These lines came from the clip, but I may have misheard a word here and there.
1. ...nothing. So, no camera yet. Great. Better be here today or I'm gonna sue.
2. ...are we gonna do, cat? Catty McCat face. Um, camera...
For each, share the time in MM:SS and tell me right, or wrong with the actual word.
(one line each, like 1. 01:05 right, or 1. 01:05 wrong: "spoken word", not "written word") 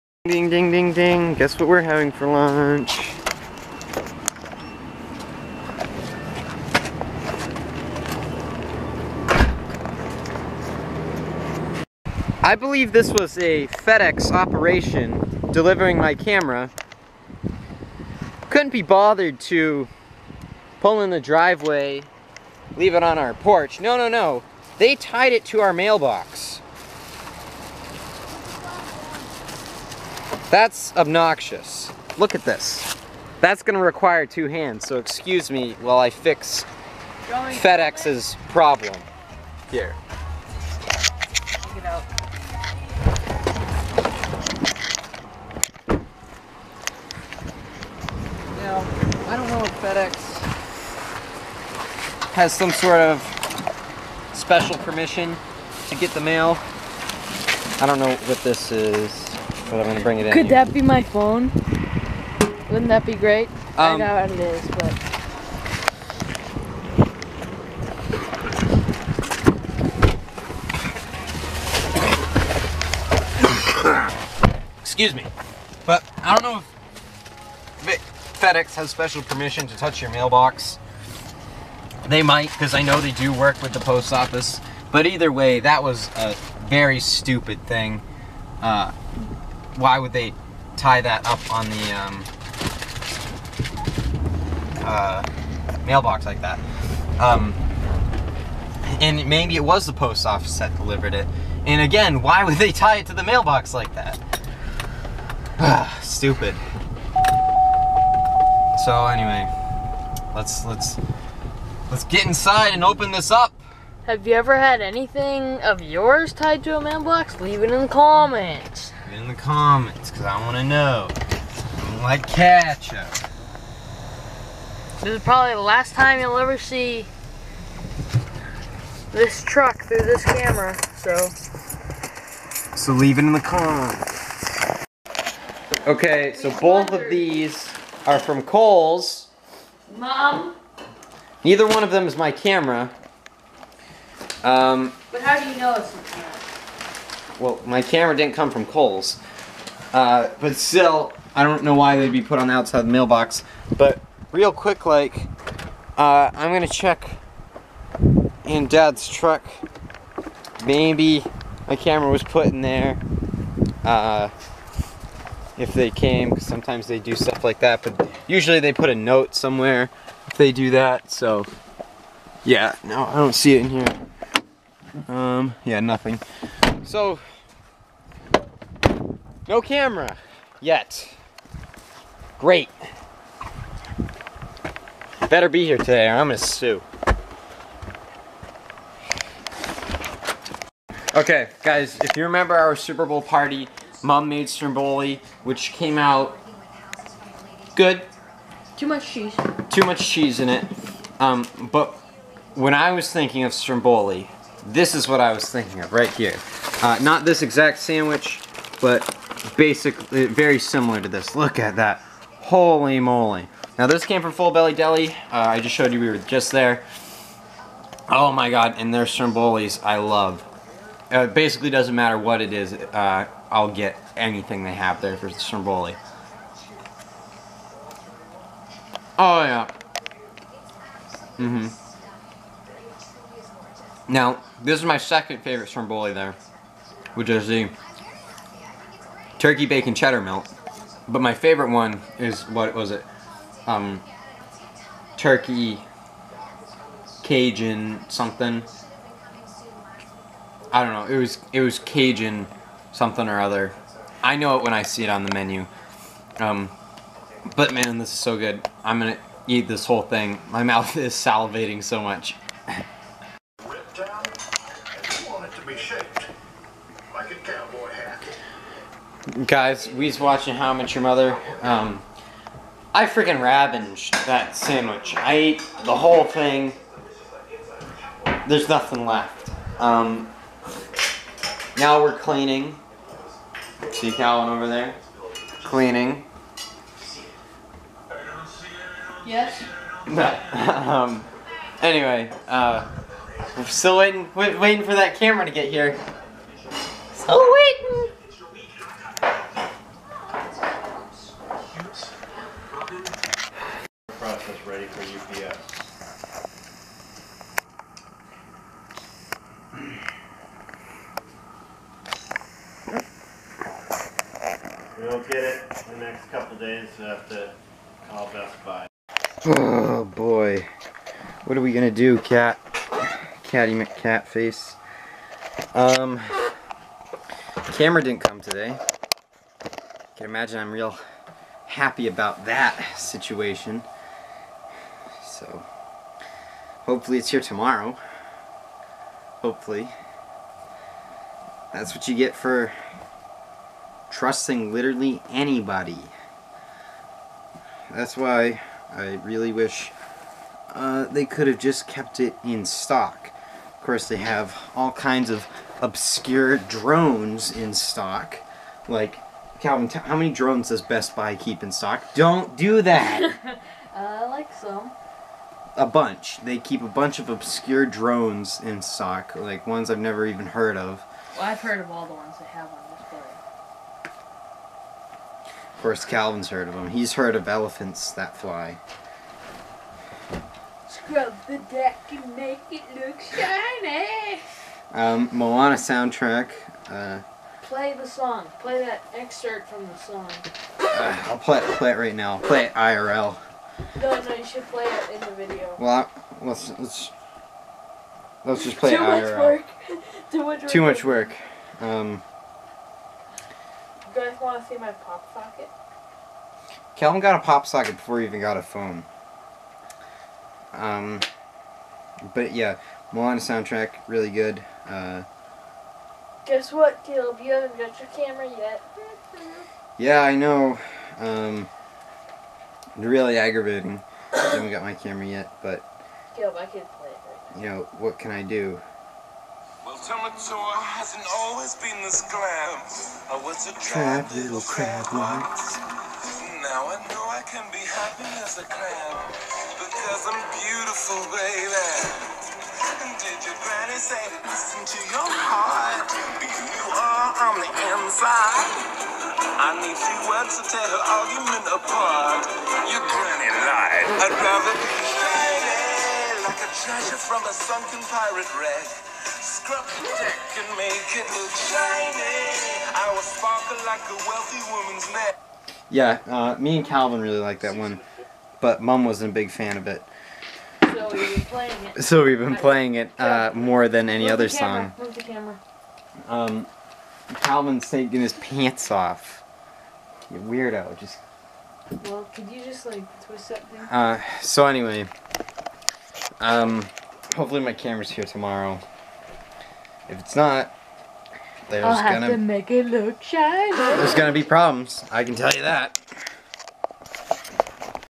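1. 02:55 right
2. 05:21 right.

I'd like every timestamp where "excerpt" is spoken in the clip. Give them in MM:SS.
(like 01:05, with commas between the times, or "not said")
06:29.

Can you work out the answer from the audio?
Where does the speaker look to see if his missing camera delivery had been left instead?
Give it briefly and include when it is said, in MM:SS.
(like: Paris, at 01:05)
Dad's truck, at 02:38.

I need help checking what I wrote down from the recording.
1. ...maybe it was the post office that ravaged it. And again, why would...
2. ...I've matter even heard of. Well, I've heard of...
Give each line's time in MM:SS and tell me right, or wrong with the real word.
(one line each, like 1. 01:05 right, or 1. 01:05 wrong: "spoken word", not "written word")
1. 01:39 wrong: "delivered", not "ravaged"
2. 06:09 wrong: "never", not "matter".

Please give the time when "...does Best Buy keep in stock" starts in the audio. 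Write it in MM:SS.
06:00.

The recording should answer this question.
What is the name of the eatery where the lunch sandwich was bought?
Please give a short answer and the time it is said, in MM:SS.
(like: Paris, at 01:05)
Full Belly Deli, at 03:34.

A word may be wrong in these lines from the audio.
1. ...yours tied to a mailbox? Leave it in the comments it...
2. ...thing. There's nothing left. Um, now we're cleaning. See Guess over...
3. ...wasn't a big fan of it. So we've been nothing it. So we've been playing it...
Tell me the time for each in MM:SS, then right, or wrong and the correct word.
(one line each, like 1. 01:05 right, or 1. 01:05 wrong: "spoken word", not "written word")
1. 01:55 right
2. 04:36 wrong: "Calvin", not "Guess"
3. 07:49 wrong: "playing", not "nothing".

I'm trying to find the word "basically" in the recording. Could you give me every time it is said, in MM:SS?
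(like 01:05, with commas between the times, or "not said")
03:29, 03:41.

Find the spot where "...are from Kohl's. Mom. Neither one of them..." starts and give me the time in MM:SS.
02:18.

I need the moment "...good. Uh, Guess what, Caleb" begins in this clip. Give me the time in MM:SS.
06:54.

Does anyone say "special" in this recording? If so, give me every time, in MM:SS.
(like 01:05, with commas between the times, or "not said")
00:54, 01:18.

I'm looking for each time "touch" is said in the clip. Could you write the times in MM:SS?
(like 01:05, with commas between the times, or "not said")
01:19.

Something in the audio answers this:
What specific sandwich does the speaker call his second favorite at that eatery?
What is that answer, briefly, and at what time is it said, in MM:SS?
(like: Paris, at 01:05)
Turkey bacon cheddar melt, at 03:59.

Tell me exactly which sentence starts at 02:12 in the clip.
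So leave it in the comments.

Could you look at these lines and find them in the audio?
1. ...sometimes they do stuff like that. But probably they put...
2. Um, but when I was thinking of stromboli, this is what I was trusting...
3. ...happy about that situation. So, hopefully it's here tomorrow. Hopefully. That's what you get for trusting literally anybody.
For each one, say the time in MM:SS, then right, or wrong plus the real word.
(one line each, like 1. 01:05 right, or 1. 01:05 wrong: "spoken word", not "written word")
1. 02:46 wrong: "usually", not "probably"
2. 03:21 wrong: "thinking", not "trusting"
3. 05:31 right.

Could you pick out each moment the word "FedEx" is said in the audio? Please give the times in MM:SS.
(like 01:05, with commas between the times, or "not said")
00:13, 00:37, 00:49, 01:18.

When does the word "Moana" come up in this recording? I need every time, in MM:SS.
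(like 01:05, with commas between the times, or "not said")
06:25, 06:53.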